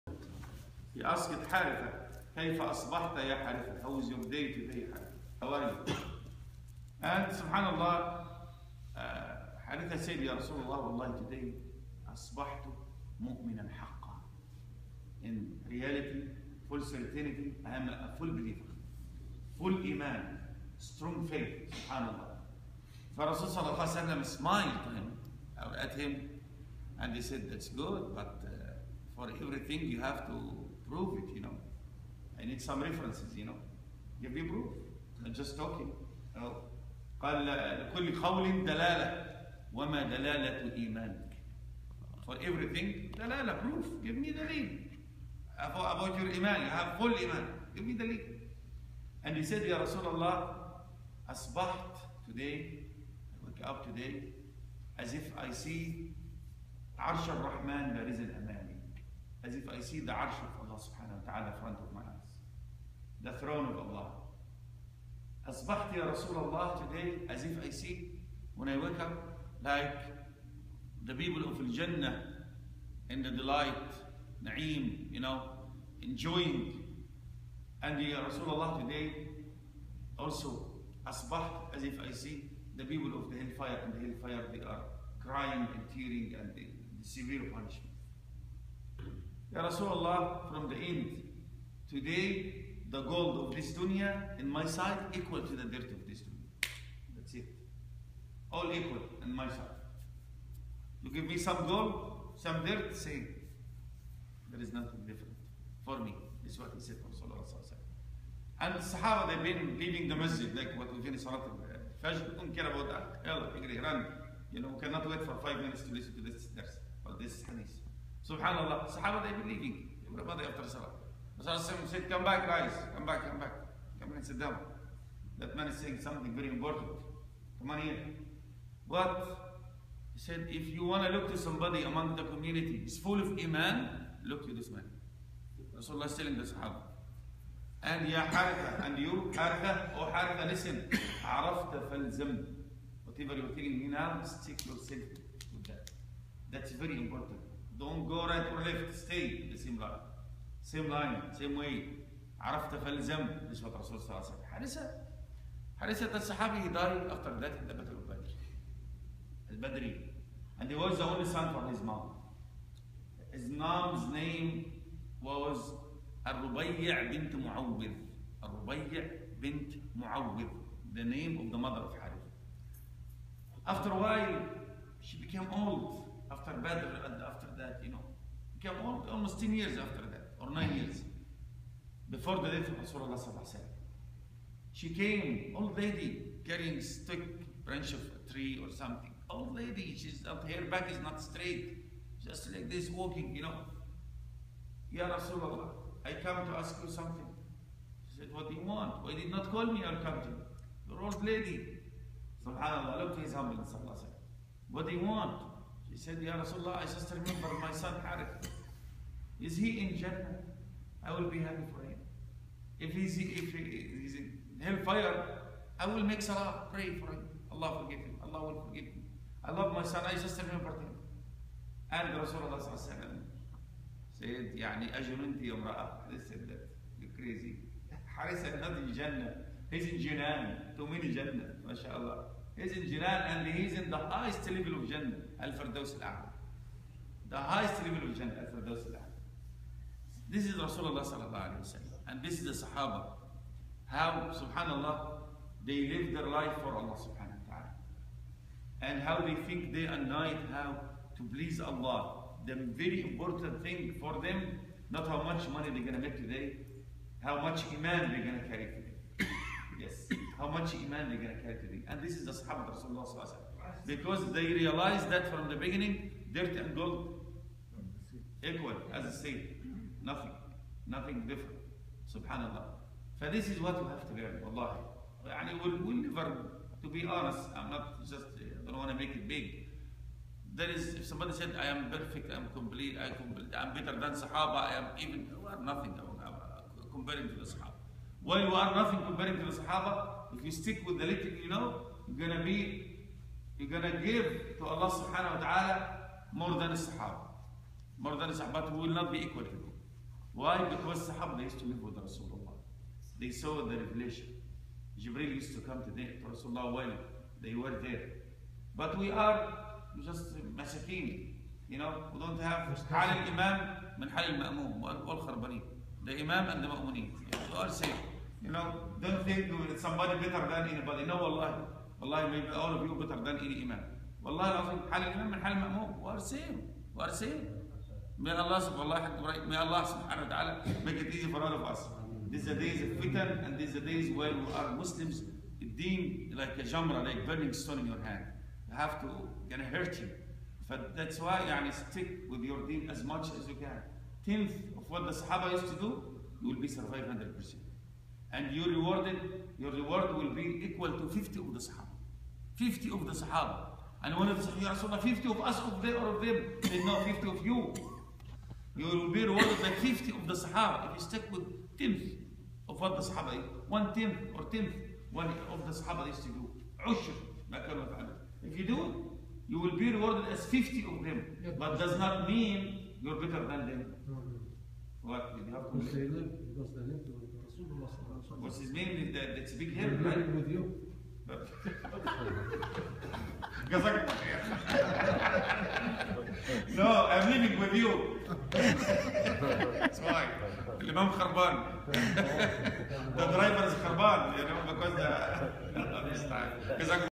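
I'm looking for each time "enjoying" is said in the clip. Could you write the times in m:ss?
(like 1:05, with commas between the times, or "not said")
1:16.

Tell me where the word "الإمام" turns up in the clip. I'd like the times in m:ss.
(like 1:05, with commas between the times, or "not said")
5:13, 6:30.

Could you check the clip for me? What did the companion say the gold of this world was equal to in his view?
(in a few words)
The dirt of this dunya.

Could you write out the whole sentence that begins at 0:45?
about your iman you have full iman give me the link.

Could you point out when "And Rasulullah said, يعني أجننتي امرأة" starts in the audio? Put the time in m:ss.
3:41.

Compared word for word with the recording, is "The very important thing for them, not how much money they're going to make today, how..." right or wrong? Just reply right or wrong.
right.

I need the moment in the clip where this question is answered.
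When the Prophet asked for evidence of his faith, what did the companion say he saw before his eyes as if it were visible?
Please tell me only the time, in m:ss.
1:03.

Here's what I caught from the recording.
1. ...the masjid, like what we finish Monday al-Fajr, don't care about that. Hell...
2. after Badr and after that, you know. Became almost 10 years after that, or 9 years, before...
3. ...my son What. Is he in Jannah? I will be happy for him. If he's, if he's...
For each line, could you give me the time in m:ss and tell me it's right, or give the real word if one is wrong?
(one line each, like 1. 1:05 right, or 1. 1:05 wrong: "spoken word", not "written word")
1. 1:50 wrong: "Salat", not "Monday"
2. 2:56 right
3. 3:27 wrong: "Harith", not "What".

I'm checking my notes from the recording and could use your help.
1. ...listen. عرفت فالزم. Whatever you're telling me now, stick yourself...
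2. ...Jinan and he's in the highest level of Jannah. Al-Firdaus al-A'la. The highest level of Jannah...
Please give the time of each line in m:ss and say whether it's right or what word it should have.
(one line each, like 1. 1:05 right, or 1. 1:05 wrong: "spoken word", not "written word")
1. 2:20 right
2. 3:52 right.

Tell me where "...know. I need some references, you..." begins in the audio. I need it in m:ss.
0:31.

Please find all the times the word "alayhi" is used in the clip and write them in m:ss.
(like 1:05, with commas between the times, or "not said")
4:01, 4:23.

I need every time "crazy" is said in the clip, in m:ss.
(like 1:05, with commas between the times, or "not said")
3:47.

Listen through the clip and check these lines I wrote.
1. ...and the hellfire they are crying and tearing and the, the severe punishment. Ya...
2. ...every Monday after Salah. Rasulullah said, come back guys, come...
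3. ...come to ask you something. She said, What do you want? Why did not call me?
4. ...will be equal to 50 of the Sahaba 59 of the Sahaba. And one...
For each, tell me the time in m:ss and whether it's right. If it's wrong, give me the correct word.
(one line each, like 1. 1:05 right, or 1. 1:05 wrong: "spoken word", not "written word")
1. 1:23 right
2. 2:00 right
3. 3:16 right
4. 5:50 wrong: "50", not "59".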